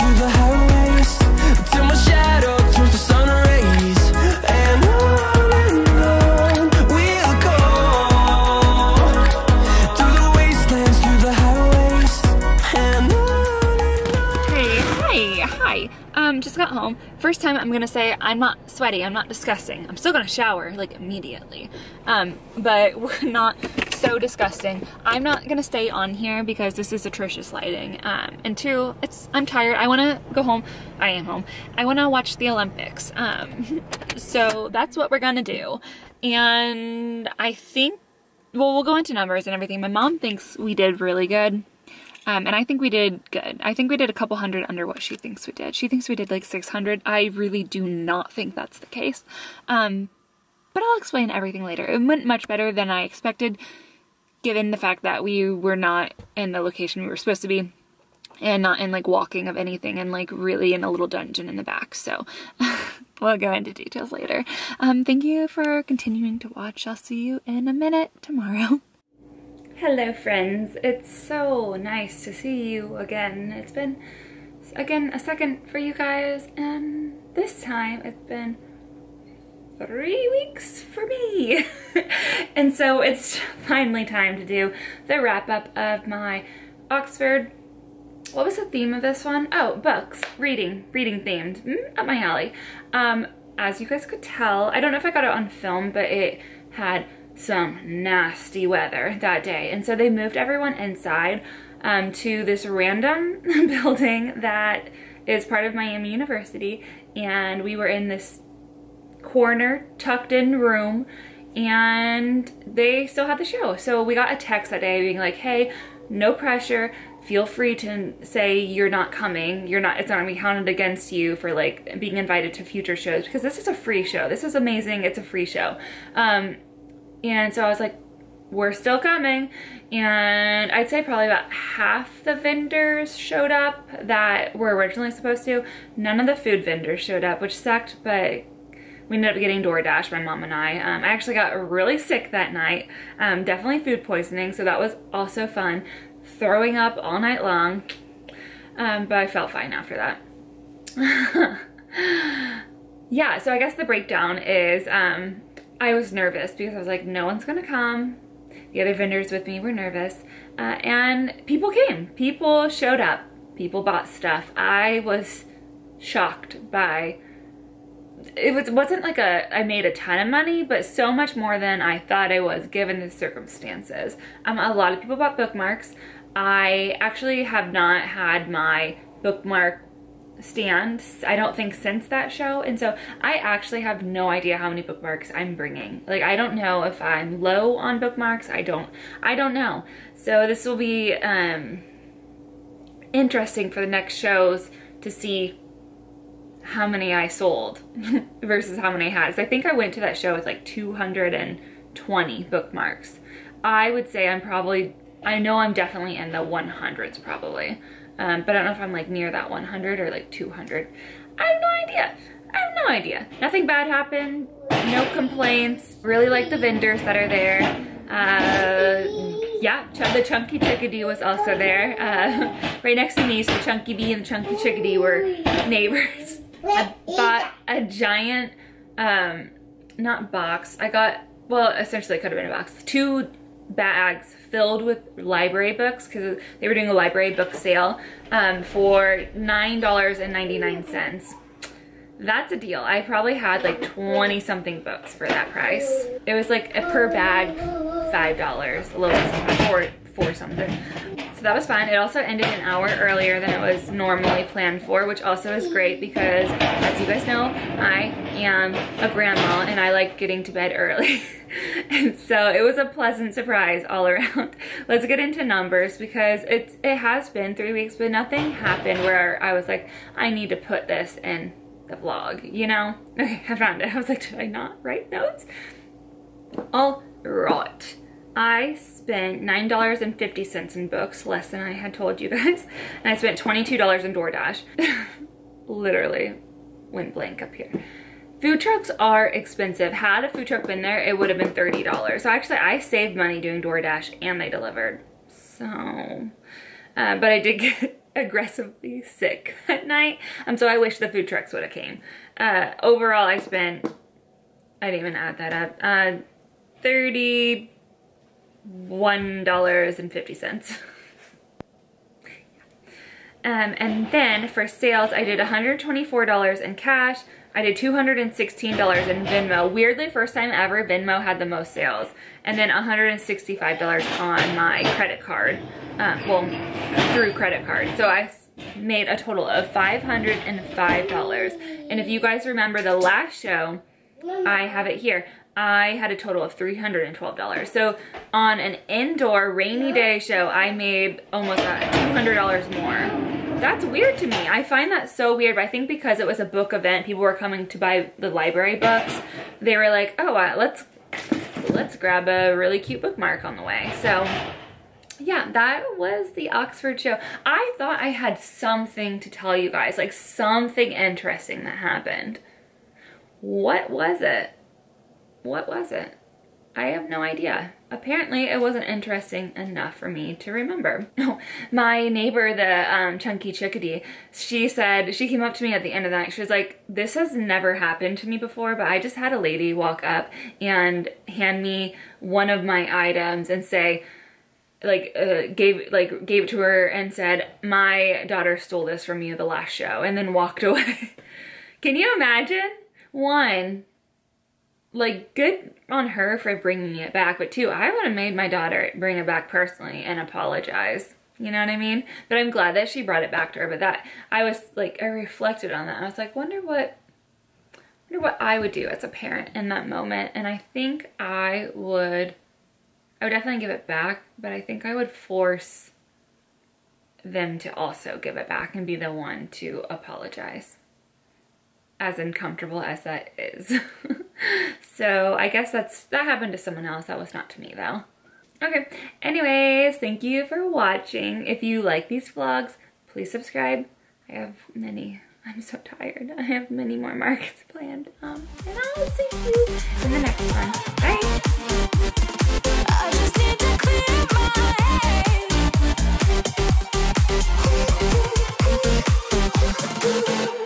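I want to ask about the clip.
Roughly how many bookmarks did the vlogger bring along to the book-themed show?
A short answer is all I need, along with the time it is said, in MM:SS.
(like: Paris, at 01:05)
220, at 03:20.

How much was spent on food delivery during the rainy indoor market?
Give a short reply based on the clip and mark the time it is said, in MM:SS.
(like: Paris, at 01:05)
$22, at 04:43.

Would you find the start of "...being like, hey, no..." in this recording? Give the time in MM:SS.
01:55.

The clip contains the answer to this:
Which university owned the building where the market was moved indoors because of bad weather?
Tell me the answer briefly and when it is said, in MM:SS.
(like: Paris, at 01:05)
Miami University, at 01:45.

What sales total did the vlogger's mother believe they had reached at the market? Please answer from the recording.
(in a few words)
600.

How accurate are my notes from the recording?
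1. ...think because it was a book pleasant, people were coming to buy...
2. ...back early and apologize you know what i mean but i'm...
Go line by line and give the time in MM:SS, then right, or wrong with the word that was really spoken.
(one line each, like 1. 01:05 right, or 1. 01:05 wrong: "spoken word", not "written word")
1. 05:45 wrong: "event", not "pleasant"
2. 06:39 wrong: "personally", not "early".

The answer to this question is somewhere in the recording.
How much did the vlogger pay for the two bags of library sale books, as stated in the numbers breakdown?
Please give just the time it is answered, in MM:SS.
04:39.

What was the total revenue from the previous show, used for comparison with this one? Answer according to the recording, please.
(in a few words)
$312.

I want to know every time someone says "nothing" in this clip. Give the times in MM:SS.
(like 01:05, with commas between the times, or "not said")
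03:33, 04:28.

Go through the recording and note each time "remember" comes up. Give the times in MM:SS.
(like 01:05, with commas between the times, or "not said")
05:32, 06:10.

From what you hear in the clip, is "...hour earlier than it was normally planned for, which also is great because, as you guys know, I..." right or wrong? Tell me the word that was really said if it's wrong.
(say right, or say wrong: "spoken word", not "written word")
right.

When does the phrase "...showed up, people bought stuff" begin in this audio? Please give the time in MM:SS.
02:42.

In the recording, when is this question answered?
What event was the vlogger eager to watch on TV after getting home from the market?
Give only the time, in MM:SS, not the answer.
00:32.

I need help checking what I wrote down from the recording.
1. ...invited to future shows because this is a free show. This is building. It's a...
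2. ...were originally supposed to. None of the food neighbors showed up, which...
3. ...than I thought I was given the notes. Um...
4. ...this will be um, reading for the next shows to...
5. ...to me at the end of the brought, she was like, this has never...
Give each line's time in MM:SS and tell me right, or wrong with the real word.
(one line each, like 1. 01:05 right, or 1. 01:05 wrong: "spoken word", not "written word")
1. 02:02 wrong: "amazing", not "building"
2. 02:14 wrong: "vendors", not "neighbors"
3. 02:51 wrong: "circumstances", not "notes"
4. 03:10 wrong: "interesting", not "reading"
5. 06:15 wrong: "night", not "brought".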